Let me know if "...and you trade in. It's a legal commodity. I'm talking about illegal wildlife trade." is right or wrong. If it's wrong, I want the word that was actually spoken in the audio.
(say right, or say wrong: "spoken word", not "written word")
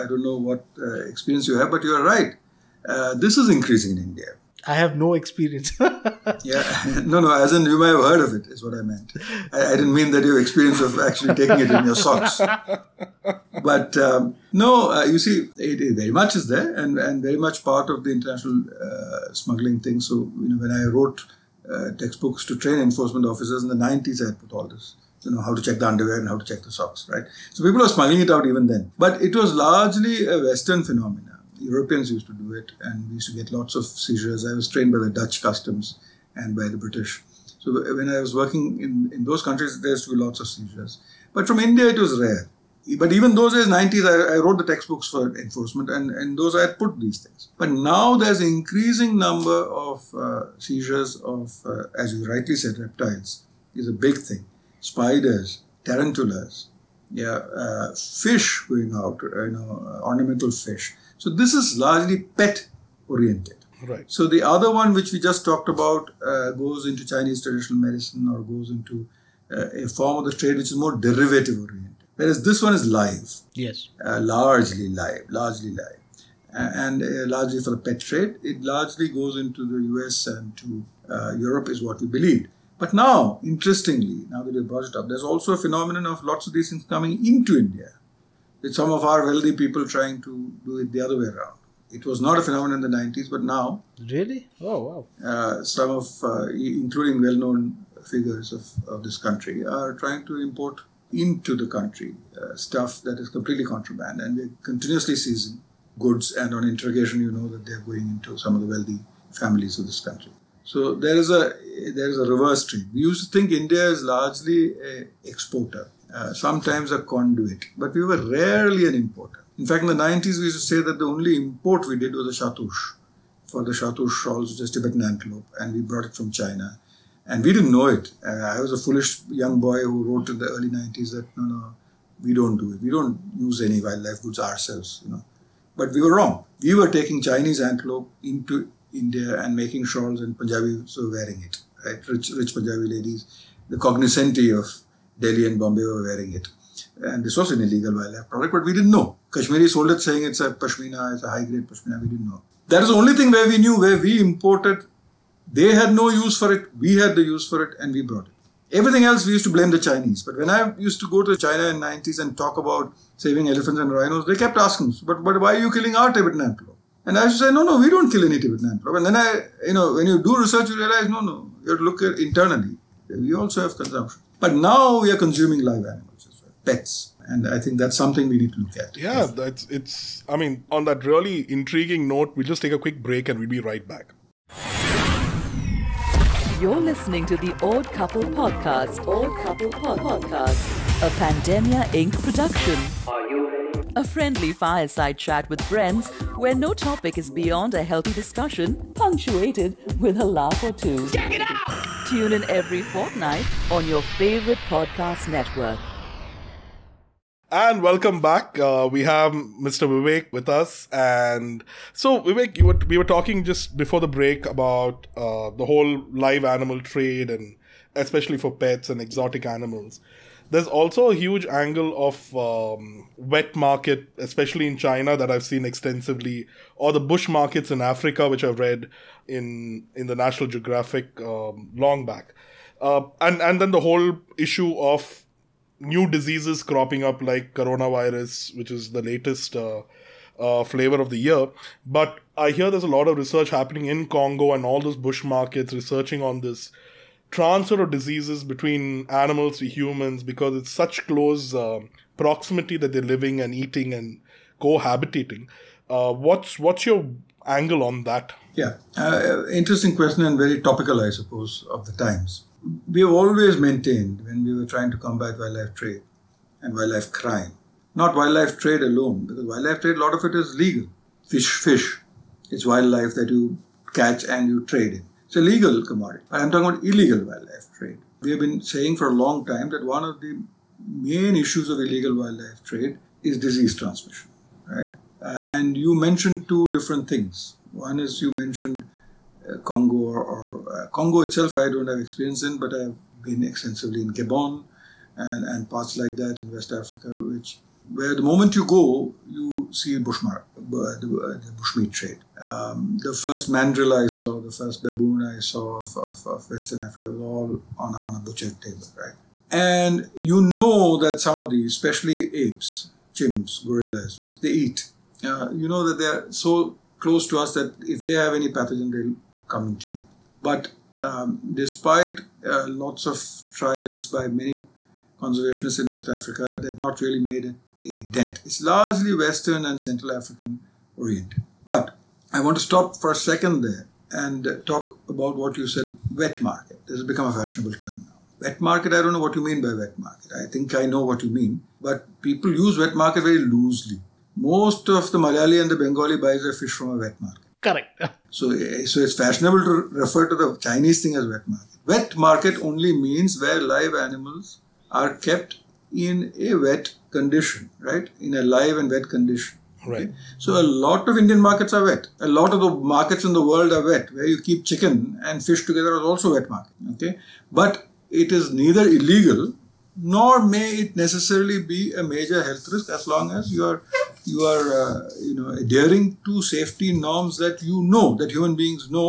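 right.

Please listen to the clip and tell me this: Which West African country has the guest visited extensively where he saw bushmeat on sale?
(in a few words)
Gabon.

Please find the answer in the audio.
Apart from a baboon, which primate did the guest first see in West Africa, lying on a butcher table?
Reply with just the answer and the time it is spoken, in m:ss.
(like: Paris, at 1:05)
Mandrill, at 5:03.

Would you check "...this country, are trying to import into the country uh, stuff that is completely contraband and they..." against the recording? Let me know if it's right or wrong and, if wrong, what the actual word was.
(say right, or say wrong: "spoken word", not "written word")
right.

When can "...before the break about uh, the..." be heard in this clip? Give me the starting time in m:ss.
3:33.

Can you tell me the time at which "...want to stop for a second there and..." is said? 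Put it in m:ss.
5:32.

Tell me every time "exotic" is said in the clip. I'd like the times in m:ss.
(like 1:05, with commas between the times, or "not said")
3:38.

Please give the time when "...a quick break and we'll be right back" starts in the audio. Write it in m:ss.
3:02.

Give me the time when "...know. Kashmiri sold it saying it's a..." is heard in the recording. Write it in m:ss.
2:28.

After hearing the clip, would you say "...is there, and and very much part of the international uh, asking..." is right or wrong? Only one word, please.
wrong.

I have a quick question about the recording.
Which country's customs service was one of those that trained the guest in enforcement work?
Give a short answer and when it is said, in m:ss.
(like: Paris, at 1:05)
Dutch, at 0:35.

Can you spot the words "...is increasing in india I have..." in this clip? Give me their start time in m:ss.
0:03.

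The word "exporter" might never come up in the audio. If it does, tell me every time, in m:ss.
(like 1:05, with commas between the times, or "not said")
1:55.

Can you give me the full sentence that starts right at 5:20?
But um, despite uh, lots of trials by many conservationists in West Africa, they've not really made it a dent.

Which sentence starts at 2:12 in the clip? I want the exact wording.
We don't use any wildlife goods ourselves, you know.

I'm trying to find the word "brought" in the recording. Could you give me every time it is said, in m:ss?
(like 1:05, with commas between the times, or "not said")
1:24, 2:05, 2:38.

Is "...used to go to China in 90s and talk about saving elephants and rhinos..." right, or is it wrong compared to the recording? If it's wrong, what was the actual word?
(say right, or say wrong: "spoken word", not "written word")
right.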